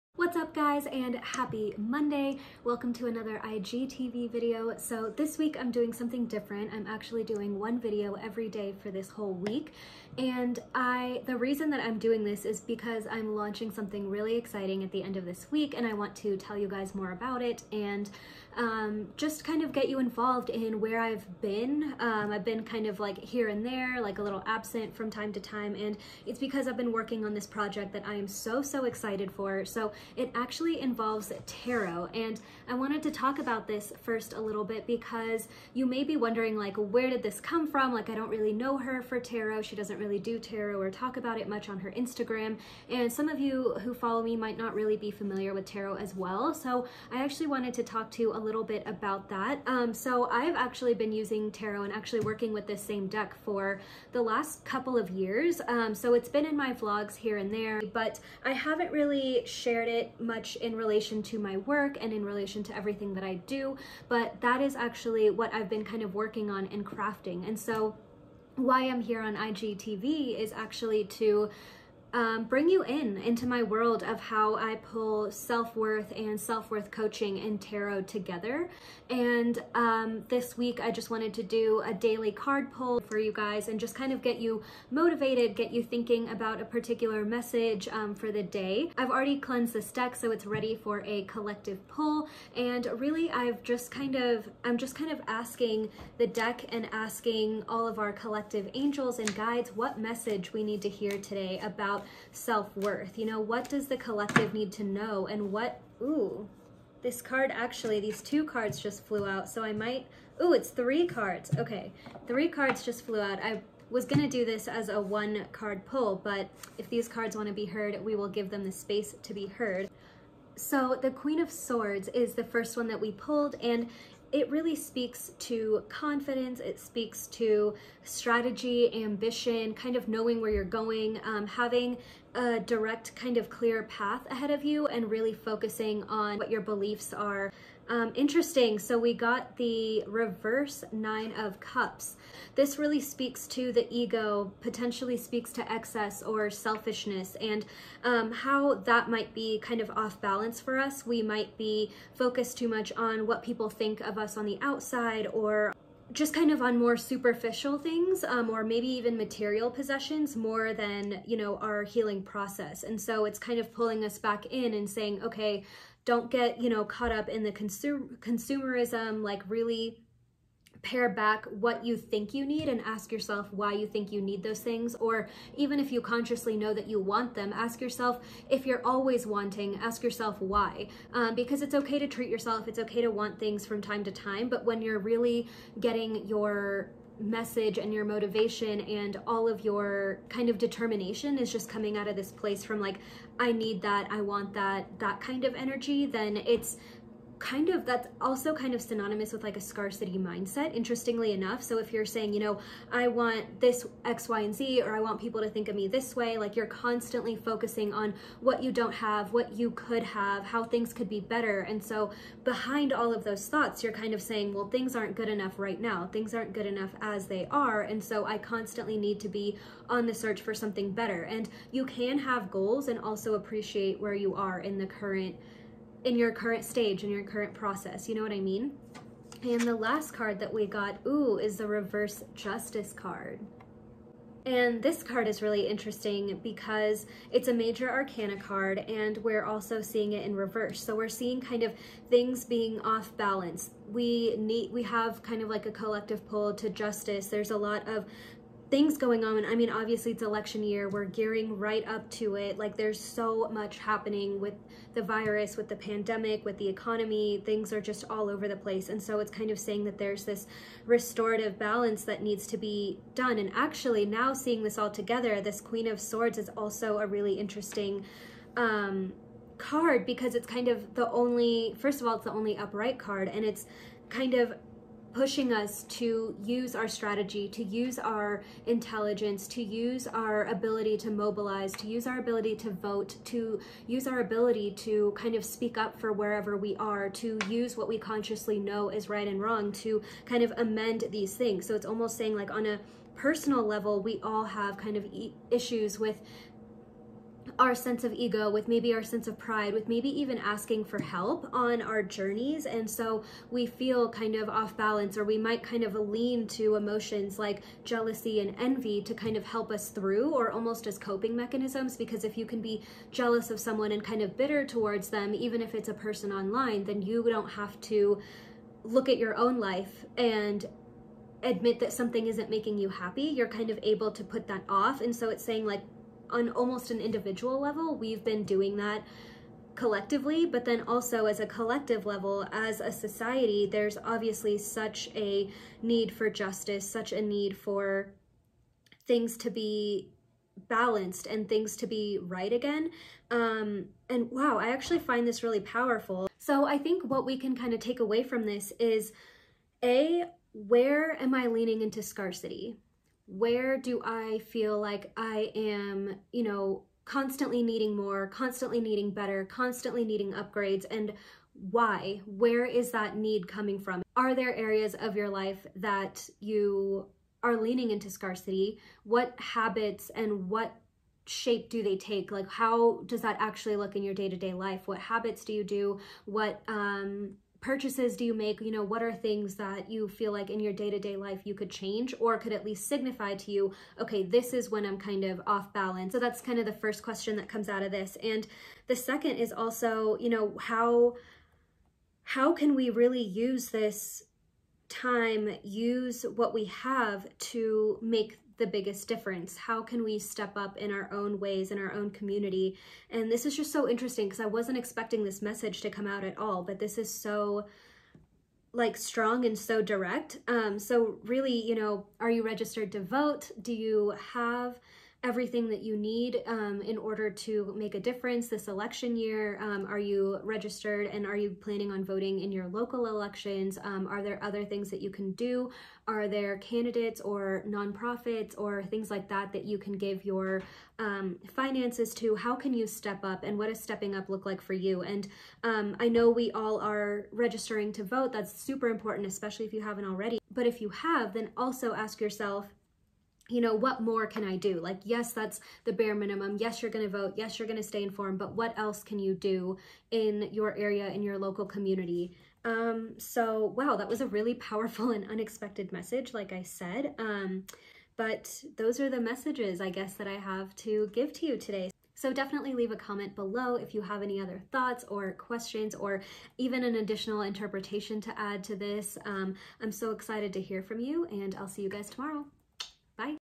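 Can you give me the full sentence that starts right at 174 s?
Or even if you consciously know that you want them, ask yourself if you're always wanting, ask yourself why.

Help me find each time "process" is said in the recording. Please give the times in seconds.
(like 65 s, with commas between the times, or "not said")
162 s, 227 s.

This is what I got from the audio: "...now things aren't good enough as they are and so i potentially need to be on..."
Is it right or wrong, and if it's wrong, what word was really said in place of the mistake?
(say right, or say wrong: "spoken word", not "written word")
wrong: "constantly", not "potentially".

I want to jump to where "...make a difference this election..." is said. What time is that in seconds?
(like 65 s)
417 s.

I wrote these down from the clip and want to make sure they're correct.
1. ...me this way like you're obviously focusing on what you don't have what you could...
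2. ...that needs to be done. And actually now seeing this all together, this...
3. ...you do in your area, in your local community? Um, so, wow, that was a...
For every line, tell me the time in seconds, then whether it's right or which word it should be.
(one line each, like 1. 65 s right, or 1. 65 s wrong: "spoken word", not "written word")
1. 205 s wrong: "constantly", not "obviously"
2. 262 s right
3. 449 s right.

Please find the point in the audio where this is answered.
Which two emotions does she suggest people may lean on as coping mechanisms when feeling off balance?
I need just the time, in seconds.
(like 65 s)
307 s.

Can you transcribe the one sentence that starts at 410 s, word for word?
Um, so really, you know, are you registered to vote?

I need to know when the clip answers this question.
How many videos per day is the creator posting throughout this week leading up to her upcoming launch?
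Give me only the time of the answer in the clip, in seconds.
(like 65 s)
7 s.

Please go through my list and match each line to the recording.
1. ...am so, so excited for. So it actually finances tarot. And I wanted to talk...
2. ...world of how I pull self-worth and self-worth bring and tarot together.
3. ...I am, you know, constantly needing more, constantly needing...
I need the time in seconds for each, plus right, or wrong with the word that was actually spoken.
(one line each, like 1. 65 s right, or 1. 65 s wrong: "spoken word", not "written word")
1. 28 s wrong: "involves", not "finances"
2. 73 s wrong: "coaching", not "bring"
3. 355 s right.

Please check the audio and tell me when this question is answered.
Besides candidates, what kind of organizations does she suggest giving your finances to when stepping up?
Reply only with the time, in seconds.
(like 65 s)
427 s.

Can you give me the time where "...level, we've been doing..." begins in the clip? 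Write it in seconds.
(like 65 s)
327 s.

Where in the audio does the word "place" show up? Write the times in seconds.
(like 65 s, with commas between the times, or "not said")
192 s, 258 s.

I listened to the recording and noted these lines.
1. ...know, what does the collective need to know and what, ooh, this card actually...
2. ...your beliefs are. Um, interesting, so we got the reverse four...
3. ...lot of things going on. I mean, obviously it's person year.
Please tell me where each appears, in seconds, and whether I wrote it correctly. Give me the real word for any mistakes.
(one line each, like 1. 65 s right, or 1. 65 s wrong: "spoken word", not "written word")
1. 103 s right
2. 136 s wrong: "nine", not "four"
3. 247 s wrong: "election", not "person".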